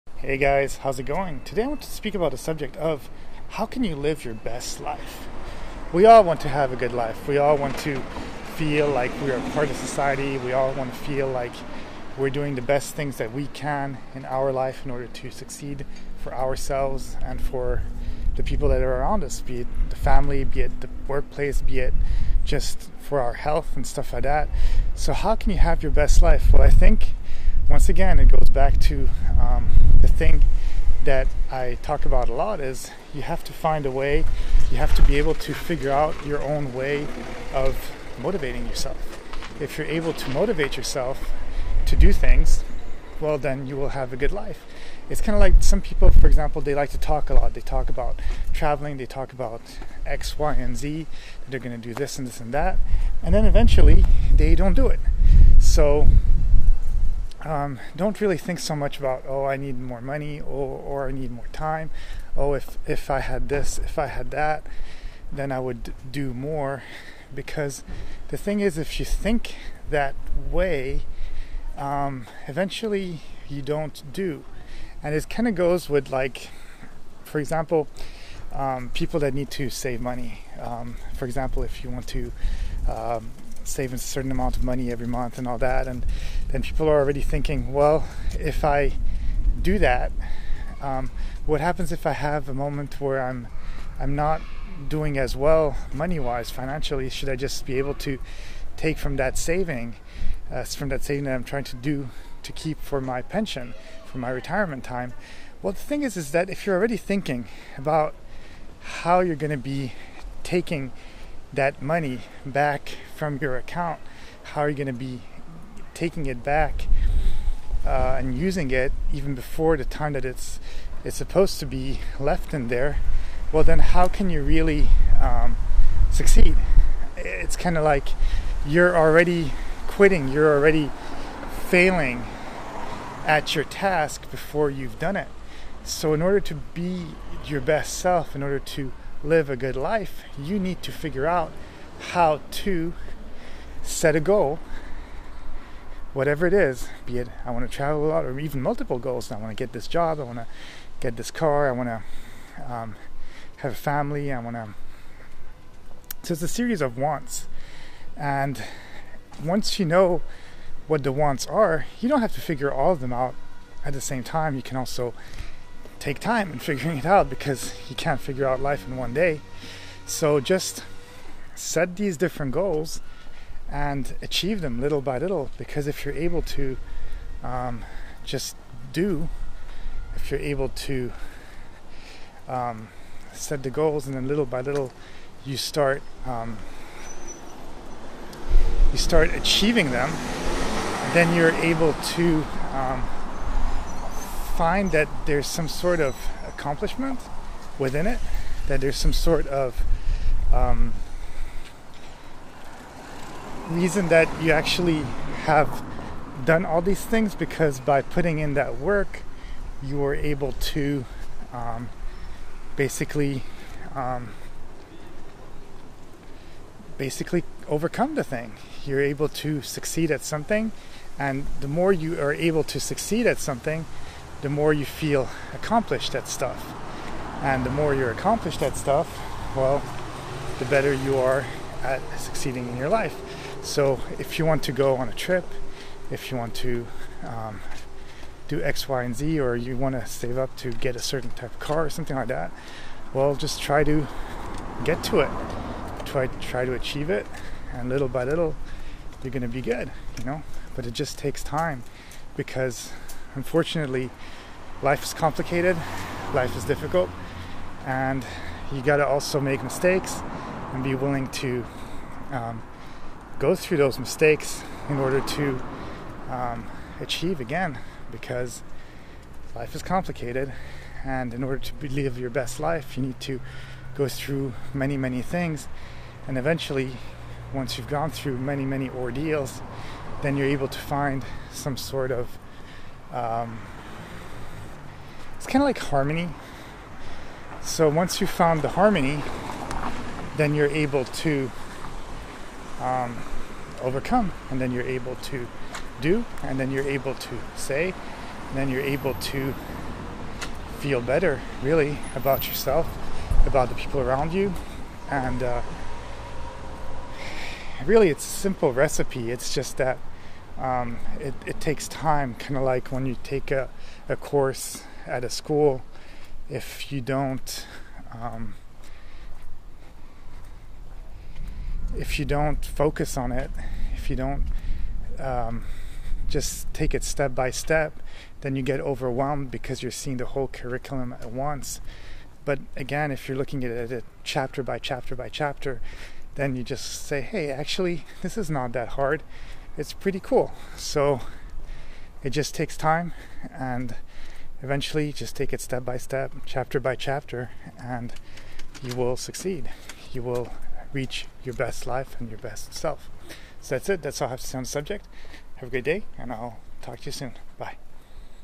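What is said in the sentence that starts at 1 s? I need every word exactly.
Today I want to speak about the subject of how can you live your best life?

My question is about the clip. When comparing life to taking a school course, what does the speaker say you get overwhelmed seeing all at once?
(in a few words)
the whole curriculum.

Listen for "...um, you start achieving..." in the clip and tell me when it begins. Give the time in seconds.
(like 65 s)
186 s.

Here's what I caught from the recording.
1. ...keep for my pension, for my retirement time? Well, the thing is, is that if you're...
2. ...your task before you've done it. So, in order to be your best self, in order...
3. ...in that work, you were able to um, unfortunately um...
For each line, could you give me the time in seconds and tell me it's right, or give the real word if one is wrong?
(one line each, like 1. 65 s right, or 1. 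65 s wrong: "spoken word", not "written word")
1. 102 s right
2. 133 s right
3. 208 s wrong: "basically", not "unfortunately".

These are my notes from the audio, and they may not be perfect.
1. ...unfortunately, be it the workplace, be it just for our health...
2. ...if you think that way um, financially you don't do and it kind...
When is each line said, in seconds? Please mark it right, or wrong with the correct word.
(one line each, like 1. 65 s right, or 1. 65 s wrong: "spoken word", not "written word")
1. 19 s wrong: "family", not "unfortunately"
2. 68 s wrong: "eventually", not "financially".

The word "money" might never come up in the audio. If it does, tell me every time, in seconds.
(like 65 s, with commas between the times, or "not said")
60 s, 80 s, 84 s, 95 s, 111 s.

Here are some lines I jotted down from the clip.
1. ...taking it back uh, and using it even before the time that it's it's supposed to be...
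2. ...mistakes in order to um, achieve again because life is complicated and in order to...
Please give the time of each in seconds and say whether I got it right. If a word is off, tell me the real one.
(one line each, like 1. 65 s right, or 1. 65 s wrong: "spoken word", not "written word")
1. 115 s right
2. 263 s right.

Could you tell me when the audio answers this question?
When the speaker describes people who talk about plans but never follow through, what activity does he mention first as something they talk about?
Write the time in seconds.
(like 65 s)
48 s.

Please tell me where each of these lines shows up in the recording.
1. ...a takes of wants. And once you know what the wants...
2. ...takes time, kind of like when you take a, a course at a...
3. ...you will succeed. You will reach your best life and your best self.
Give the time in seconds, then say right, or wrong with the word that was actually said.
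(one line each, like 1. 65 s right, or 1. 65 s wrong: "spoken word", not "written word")
1. 156 s wrong: "series", not "takes"
2. 311 s right
3. 348 s right.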